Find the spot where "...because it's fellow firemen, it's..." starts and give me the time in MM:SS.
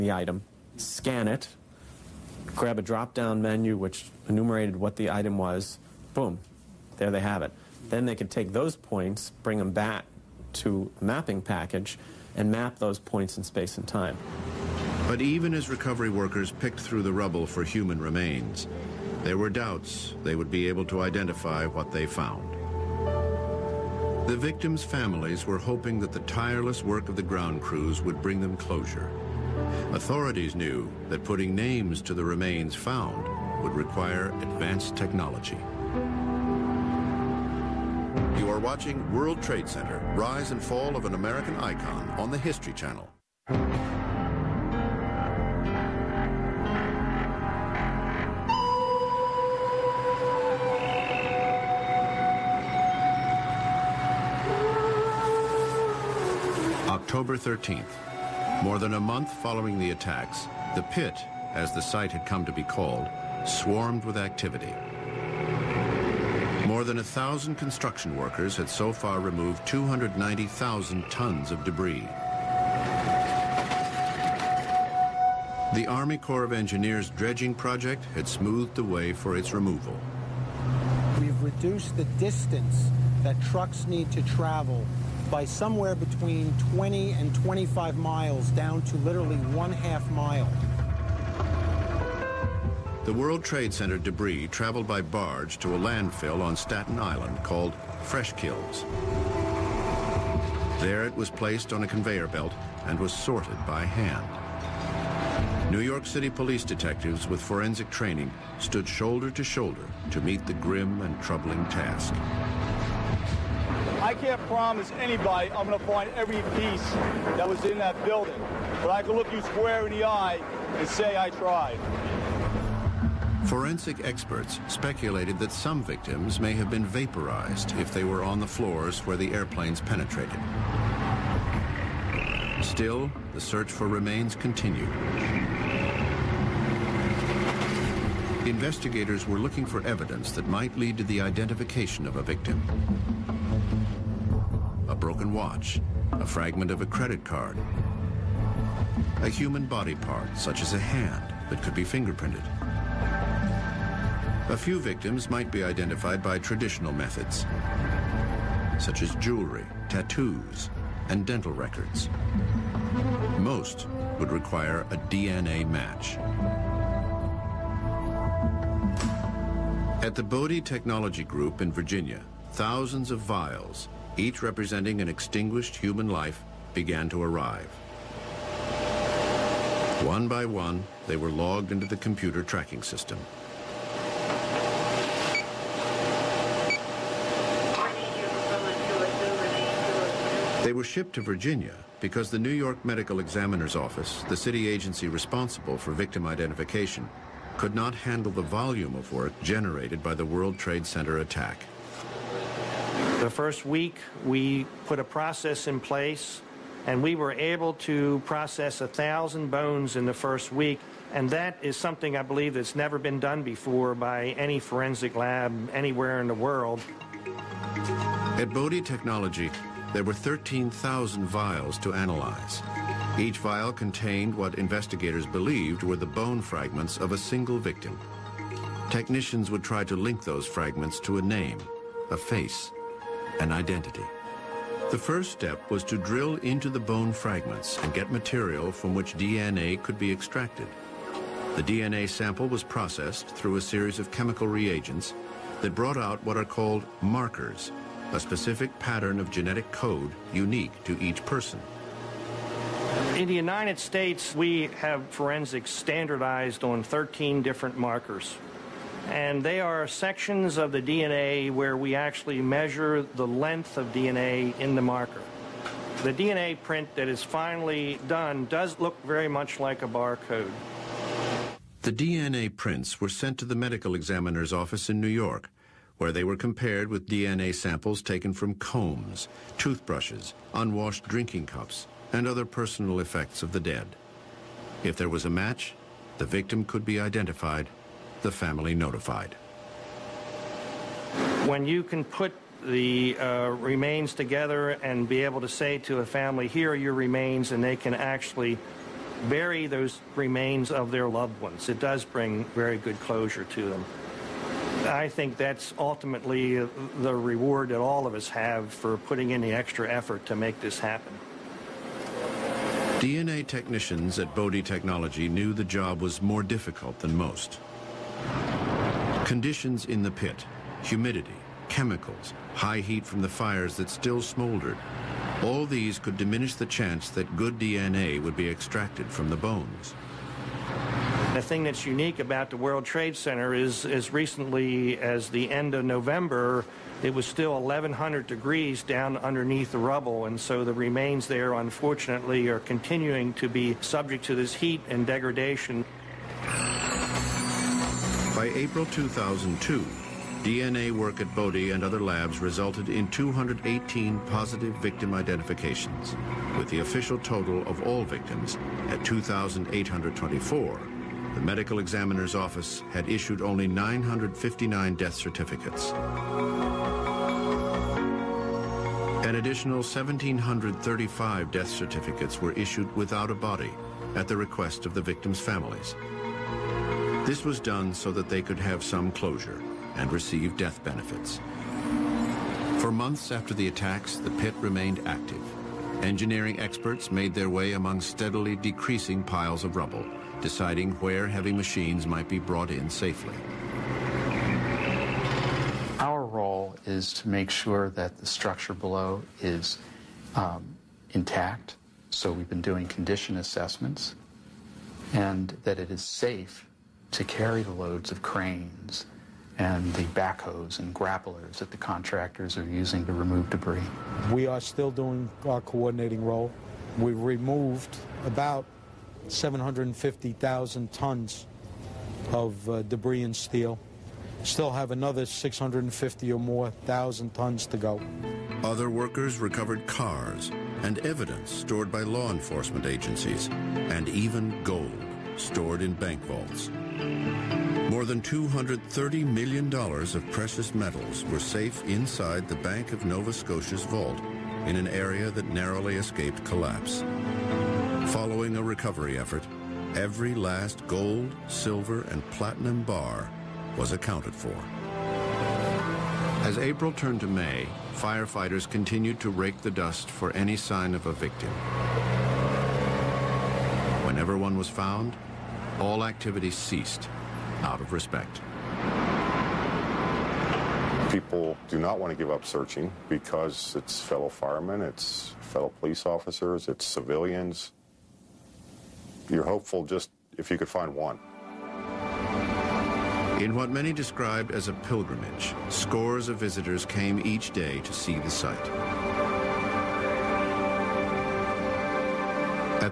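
07:53.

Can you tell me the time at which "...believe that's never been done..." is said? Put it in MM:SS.
03:32.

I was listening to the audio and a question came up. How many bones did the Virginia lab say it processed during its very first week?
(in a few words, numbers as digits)
1,000.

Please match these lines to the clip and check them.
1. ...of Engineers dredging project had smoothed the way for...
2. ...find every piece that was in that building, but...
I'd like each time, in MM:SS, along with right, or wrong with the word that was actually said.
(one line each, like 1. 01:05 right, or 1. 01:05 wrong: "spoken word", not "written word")
1. 01:16 right
2. 01:55 right.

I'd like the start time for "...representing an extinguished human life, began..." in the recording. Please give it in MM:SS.
02:54.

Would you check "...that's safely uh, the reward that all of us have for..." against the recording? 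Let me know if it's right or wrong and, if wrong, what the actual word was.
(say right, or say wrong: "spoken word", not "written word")
wrong: "ultimately", not "safely".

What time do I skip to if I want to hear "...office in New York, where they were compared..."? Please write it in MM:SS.
04:34.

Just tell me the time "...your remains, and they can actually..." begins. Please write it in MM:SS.
04:56.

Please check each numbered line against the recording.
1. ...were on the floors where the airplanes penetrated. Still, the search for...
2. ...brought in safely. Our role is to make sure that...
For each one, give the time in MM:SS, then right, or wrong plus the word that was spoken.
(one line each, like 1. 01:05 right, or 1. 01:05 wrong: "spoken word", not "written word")
1. 02:08 right
2. 06:32 right.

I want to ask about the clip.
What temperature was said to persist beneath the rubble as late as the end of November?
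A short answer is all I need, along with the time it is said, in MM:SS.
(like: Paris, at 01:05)
1,100 degrees, at 05:37.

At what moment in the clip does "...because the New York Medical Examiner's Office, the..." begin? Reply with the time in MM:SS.
03:12.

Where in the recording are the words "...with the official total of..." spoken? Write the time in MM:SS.
05:56.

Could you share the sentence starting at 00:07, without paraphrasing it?
Then they could take those points, bring them back to a mapping package, and map those points in space and time.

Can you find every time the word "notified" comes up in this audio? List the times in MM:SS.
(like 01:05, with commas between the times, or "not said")
04:48.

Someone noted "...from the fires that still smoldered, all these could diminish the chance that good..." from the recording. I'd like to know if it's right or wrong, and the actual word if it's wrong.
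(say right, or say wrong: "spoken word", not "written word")
right.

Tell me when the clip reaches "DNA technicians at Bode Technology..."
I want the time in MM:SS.
05:12.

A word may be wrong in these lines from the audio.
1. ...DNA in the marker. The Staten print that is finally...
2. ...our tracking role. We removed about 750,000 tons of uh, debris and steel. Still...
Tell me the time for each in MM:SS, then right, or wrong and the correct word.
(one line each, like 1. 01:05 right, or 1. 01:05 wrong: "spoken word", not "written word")
1. 04:23 wrong: "DNA", not "Staten"
2. 06:55 wrong: "coordinating", not "tracking".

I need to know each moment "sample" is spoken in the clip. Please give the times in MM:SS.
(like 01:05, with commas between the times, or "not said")
04:02, 04:37.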